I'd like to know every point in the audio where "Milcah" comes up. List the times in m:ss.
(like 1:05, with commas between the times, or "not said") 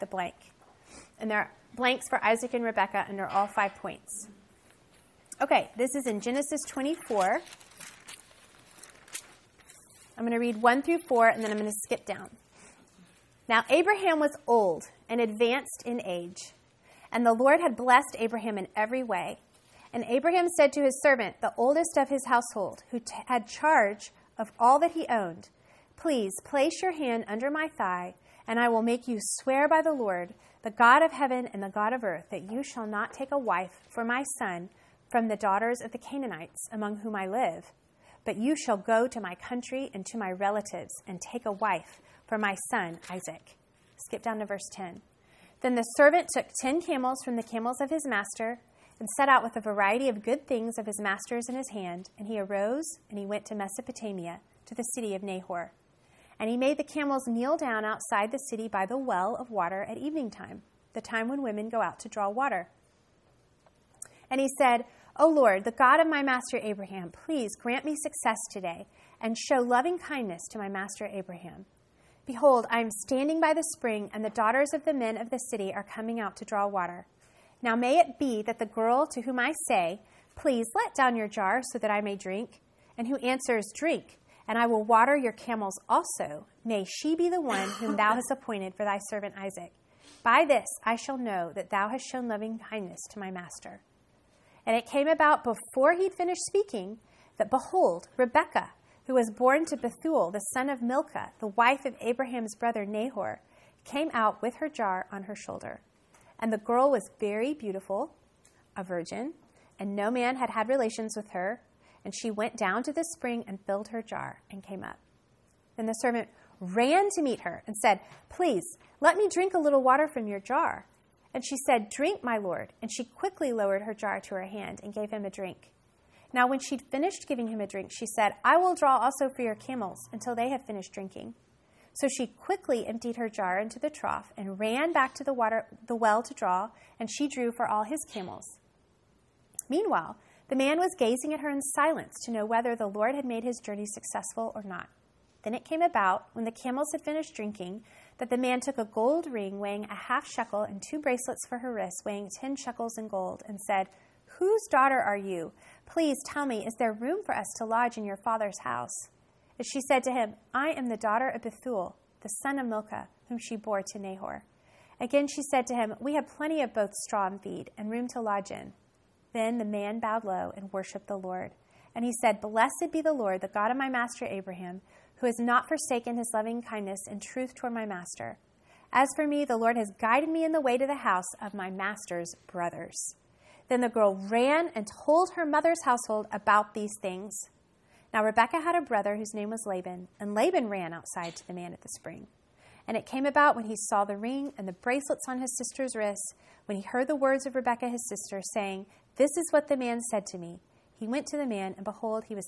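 1:40, 2:42.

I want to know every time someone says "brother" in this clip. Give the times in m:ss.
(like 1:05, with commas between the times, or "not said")
1:42, 3:02, 3:08.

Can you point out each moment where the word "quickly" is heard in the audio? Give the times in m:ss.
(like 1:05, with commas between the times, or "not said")
2:03, 2:12.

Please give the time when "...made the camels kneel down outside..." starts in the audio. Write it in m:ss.
0:56.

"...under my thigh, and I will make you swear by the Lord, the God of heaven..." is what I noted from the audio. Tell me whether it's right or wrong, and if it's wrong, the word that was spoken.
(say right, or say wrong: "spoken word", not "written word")
right.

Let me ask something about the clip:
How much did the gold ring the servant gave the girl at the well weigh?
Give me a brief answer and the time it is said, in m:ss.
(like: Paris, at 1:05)
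Half shekel, at 2:29.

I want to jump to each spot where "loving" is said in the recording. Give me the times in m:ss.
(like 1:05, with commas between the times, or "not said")
1:09, 1:32, 2:56.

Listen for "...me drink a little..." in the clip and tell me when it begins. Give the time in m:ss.
1:59.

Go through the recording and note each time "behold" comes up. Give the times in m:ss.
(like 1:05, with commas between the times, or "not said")
1:12, 1:37, 3:21.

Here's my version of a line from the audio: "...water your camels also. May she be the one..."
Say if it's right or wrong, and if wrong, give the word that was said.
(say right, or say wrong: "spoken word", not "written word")
right.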